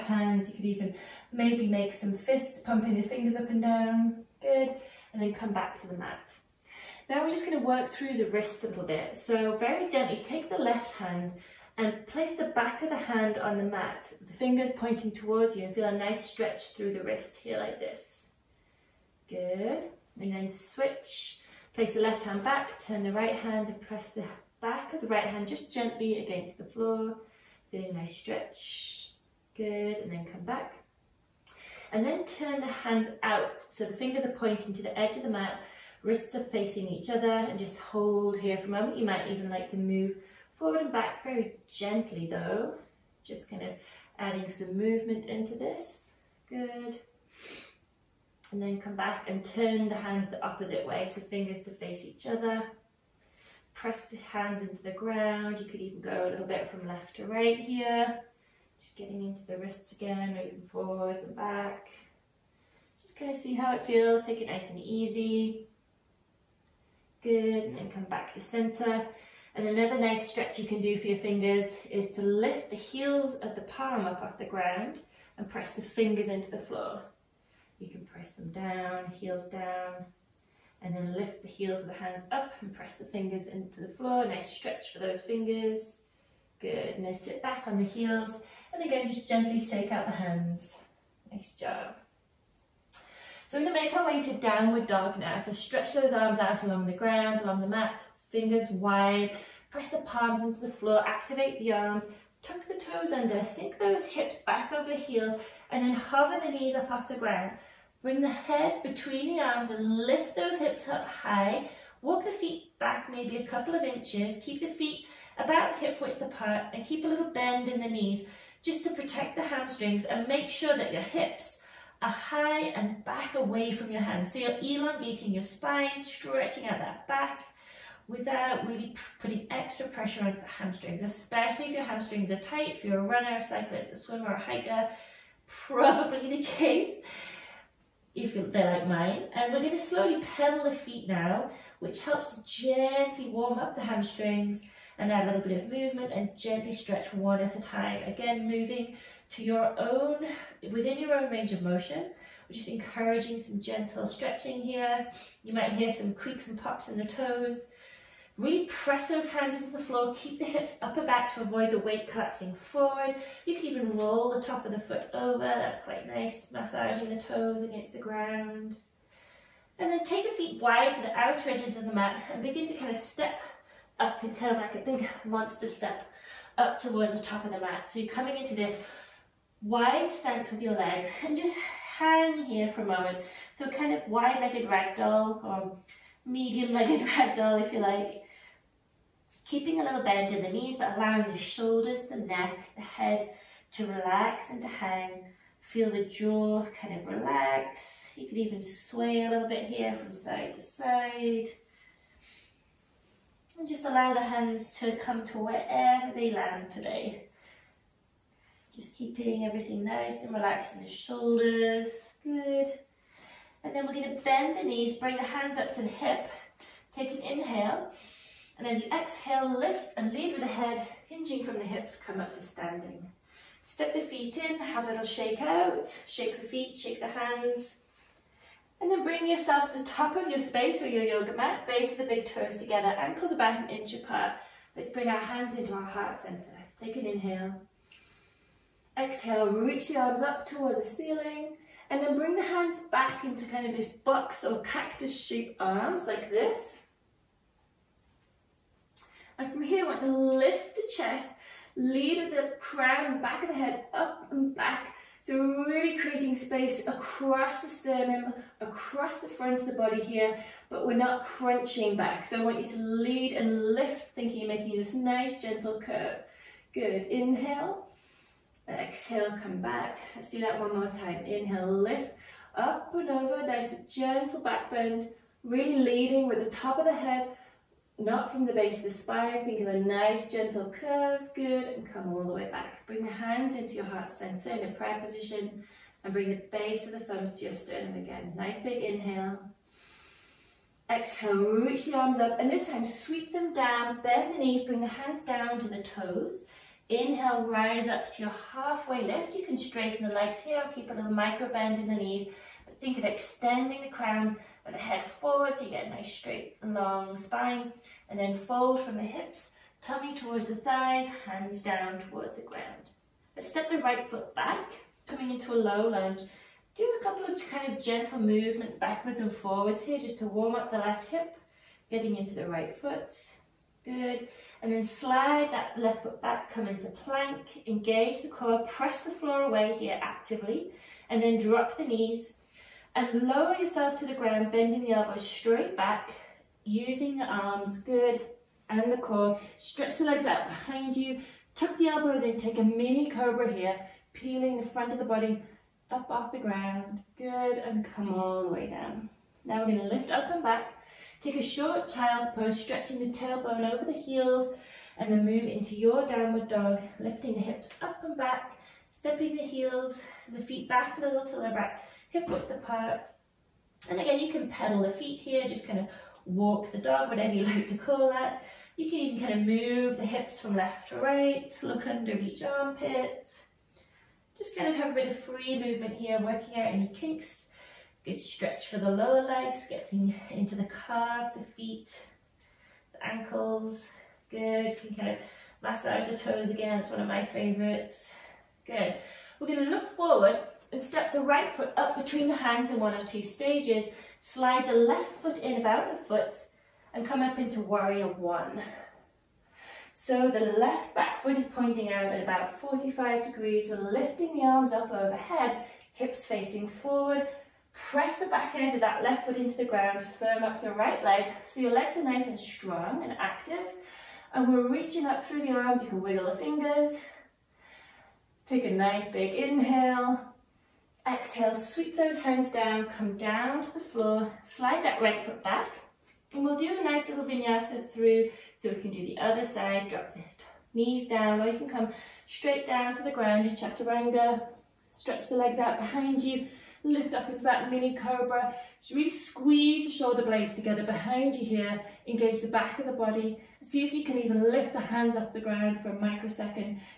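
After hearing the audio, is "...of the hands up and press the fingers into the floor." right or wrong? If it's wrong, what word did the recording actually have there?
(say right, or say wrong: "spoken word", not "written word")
right.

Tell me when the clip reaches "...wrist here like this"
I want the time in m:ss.
0:17.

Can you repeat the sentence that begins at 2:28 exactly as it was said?
Again, moving to your own, within your own range of motion.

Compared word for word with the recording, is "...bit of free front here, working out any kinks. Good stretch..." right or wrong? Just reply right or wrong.
wrong.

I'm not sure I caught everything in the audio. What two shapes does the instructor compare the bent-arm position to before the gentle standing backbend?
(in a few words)
box or cactus.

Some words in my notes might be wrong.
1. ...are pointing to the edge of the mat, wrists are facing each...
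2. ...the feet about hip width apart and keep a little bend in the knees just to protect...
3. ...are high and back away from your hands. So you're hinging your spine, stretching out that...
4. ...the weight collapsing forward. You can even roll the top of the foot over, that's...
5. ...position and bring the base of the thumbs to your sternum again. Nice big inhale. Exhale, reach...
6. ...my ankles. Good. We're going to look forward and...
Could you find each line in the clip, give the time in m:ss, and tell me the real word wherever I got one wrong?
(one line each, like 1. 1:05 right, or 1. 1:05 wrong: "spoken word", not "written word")
1. 0:34 right
2. 1:54 right
3. 2:02 wrong: "elongating", not "hinging"
4. 2:41 right
5. 4:45 right
6. 6:27 wrong: "favorites", not "ankles".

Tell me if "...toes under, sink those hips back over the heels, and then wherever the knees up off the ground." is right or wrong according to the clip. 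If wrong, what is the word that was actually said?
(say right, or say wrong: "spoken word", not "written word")
wrong: "hover", not "wherever".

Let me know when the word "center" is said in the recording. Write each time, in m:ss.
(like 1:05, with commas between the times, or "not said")
1:08, 3:56, 4:44.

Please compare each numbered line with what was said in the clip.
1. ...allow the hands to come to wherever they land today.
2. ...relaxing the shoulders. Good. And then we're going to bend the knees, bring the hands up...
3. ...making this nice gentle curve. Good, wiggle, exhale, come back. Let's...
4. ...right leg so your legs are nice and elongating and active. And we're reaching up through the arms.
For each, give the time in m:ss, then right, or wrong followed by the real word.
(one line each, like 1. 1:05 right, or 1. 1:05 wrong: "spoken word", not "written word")
1. 3:23 right
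2. 3:30 right
3. 4:24 wrong: "inhale", not "wiggle"
4. 6:50 wrong: "strong", not "elongating".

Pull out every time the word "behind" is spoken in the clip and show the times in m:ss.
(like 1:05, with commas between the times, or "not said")
5:40, 7:15, 7:20.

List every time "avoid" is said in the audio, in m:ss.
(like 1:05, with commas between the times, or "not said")
2:41.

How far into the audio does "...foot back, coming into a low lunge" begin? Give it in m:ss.
5:14.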